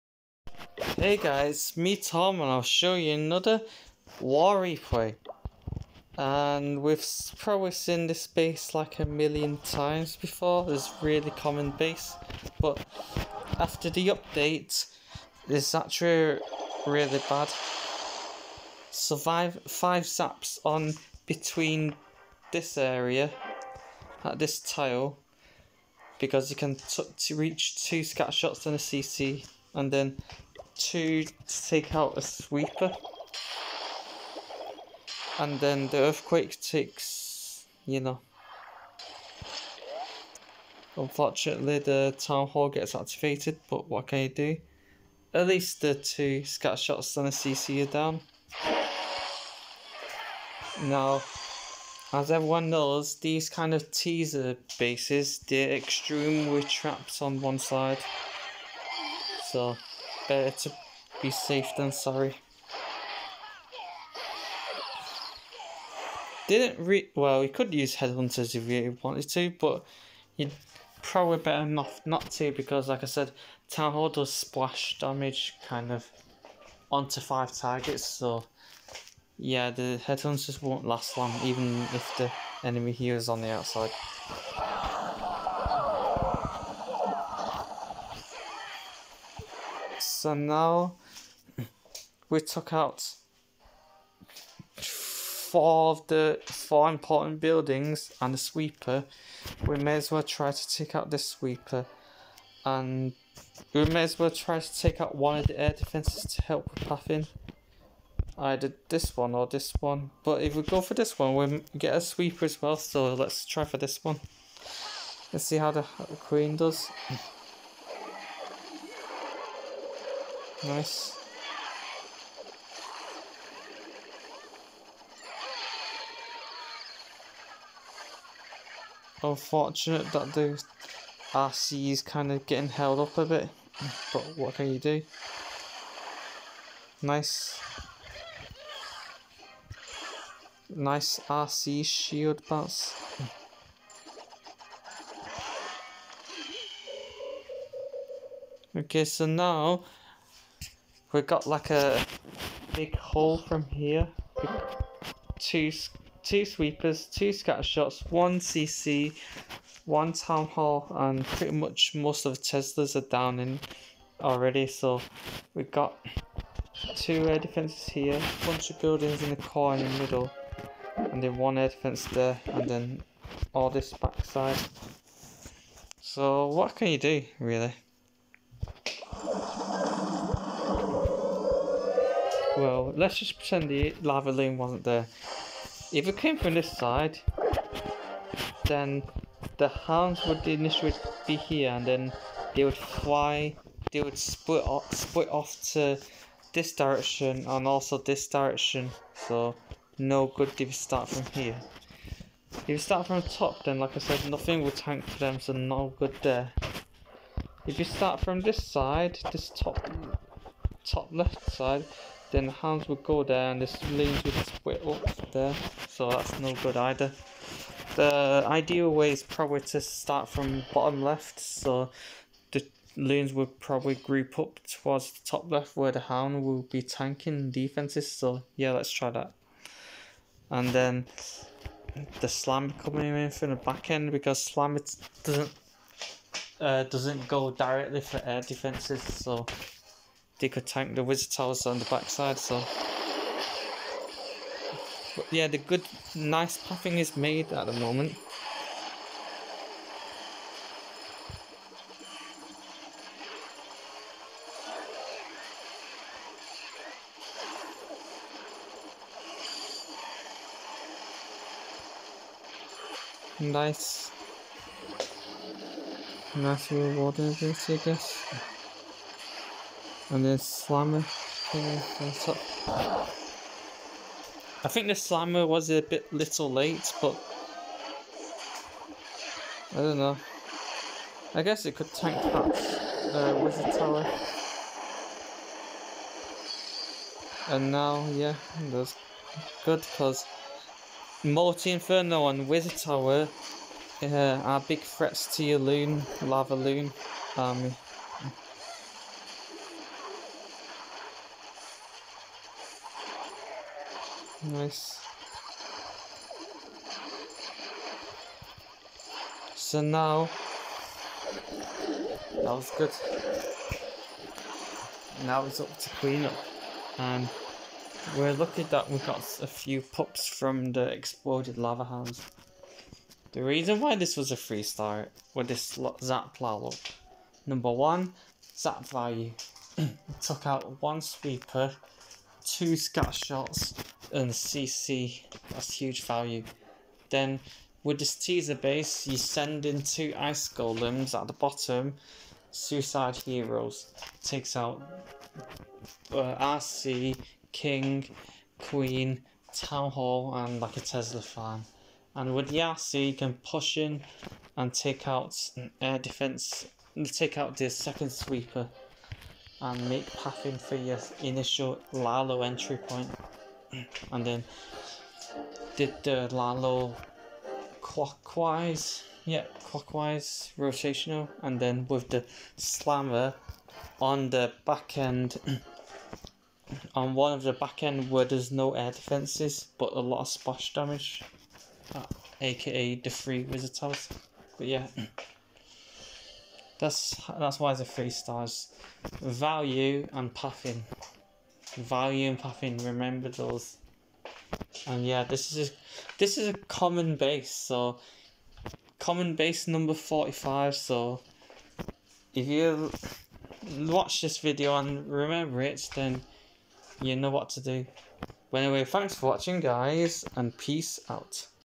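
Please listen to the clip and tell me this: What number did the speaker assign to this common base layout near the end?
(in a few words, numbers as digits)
45.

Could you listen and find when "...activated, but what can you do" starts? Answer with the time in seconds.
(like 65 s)
42 s.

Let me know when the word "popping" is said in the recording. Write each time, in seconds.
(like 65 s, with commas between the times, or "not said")
392 s.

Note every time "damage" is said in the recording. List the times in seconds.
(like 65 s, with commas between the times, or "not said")
74 s, 380 s.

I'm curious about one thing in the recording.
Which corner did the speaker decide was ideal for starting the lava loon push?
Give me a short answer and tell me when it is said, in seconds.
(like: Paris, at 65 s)
Bottom left, at 220 s.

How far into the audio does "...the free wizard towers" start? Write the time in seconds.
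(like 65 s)
383 s.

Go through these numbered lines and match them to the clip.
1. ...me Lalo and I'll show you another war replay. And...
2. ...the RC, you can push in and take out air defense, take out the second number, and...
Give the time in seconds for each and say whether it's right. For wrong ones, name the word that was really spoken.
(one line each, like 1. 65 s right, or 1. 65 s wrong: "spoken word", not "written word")
1. 1 s wrong: "Tom", not "Lalo"
2. 352 s wrong: "sweeper", not "number".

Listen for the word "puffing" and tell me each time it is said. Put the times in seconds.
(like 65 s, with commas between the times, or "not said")
390 s.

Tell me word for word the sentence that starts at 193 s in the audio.
They would split off, split off to this direction and also this direction.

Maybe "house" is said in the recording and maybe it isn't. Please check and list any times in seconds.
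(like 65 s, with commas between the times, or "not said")
321 s.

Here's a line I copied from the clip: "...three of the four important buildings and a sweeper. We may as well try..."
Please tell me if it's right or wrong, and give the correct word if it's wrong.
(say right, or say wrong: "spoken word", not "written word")
wrong: "four", not "three".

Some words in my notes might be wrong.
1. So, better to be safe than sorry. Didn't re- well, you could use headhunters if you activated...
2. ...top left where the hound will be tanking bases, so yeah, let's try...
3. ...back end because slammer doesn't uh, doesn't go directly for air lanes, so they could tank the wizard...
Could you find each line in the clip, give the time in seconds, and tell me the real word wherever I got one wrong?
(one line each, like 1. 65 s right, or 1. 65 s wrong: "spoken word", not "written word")
1. 59 s wrong: "wanted", not "activated"
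2. 225 s wrong: "defenses", not "bases"
3. 233 s wrong: "defenses", not "lanes".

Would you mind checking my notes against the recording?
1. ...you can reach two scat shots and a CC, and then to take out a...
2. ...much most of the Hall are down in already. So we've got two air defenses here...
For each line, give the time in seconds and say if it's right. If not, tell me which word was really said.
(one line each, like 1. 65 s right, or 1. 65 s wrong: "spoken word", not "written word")
1. 26 s right
2. 161 s wrong: "Teslas", not "Hall".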